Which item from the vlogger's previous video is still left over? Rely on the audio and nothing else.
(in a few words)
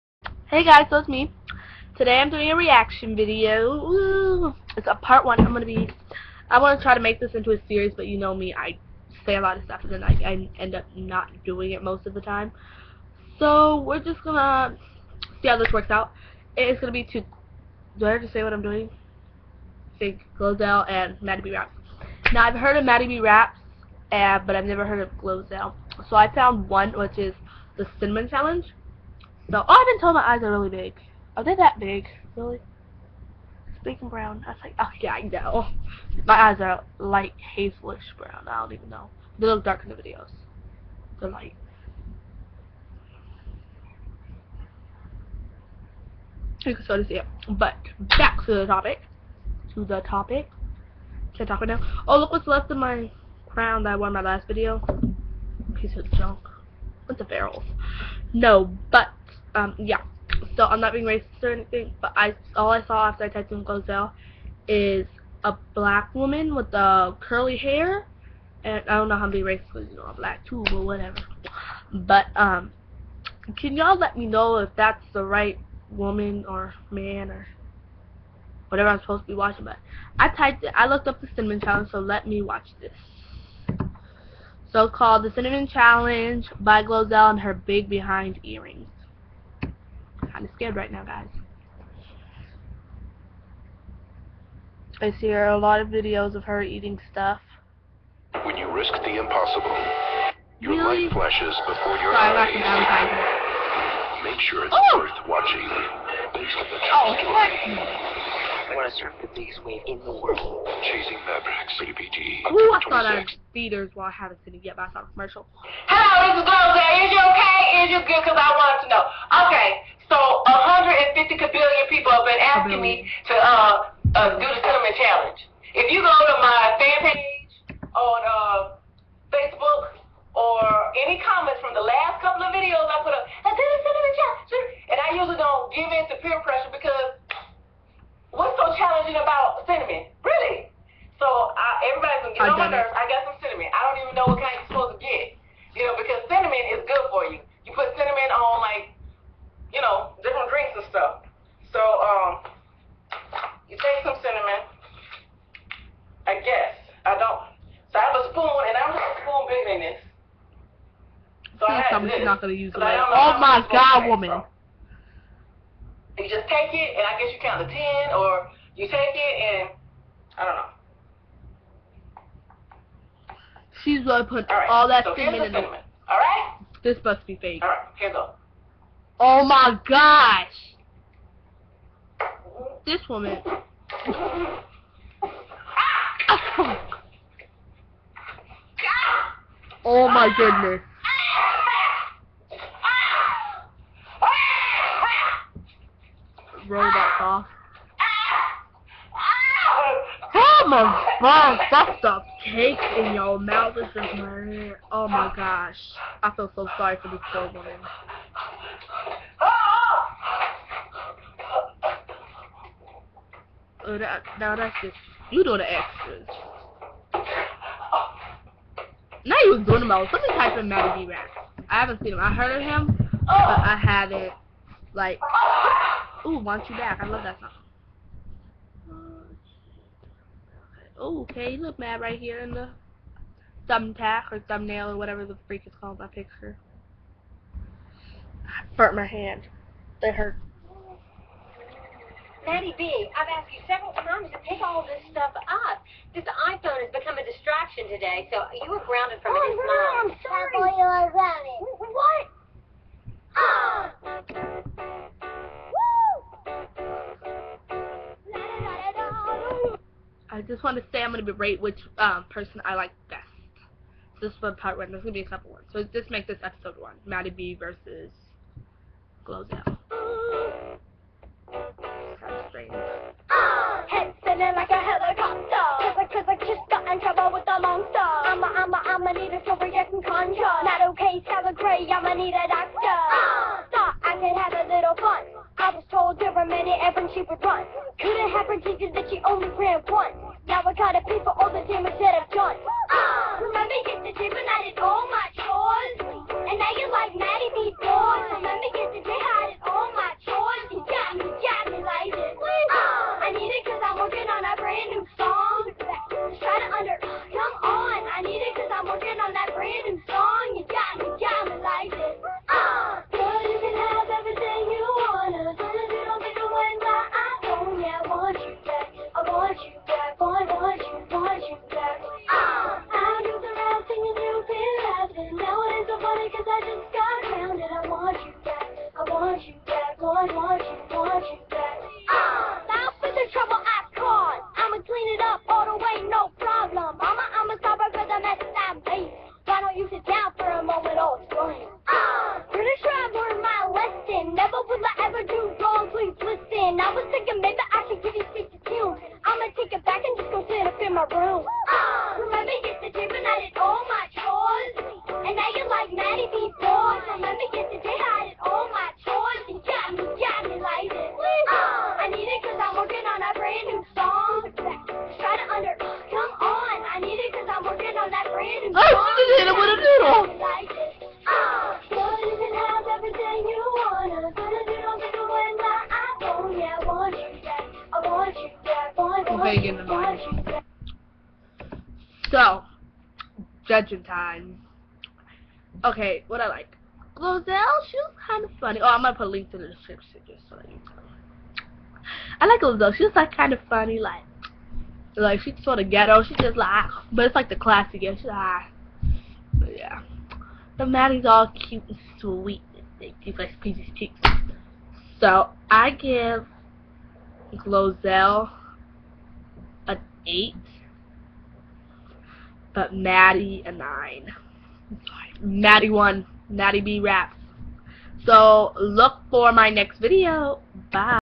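crown.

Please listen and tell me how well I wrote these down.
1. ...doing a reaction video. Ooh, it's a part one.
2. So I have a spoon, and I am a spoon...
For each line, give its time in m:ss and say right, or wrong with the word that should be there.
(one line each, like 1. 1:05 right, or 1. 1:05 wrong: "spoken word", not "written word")
1. 0:02 right
2. 2:37 right.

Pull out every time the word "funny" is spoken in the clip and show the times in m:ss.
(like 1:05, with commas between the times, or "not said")
6:28, 6:33.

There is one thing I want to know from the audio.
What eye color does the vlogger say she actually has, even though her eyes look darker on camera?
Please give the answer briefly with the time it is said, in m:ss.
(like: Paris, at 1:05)
light hazelish brown, at 0:36.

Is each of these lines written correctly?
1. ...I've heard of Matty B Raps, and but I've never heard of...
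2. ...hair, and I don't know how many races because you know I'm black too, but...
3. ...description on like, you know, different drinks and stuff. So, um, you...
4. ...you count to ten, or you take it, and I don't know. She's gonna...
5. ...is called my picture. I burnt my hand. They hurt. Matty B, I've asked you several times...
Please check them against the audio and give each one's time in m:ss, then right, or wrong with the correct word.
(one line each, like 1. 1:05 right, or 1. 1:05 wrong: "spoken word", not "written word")
1. 0:22 right
2. 1:07 right
3. 2:27 wrong: "cinnamon", not "description"
4. 2:47 right
5. 3:55 right.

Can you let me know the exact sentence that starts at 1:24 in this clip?
So called the cinnamon challenge by Glozell and her big behind earrings kind of scared right now, guys.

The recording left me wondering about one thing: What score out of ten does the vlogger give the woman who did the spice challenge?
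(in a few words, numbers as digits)
8.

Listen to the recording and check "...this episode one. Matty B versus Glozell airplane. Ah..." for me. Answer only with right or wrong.
right.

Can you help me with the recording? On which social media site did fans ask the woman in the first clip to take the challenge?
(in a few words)
Facebook.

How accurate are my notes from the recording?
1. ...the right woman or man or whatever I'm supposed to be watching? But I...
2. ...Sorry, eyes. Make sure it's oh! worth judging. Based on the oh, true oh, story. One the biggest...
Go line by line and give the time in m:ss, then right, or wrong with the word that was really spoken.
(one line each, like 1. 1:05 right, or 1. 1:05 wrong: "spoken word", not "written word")
1. 1:15 right
2. 1:42 wrong: "watching", not "judging".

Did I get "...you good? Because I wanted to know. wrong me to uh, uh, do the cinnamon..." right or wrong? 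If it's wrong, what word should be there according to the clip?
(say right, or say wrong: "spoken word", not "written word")
wrong: "asking", not "wrong".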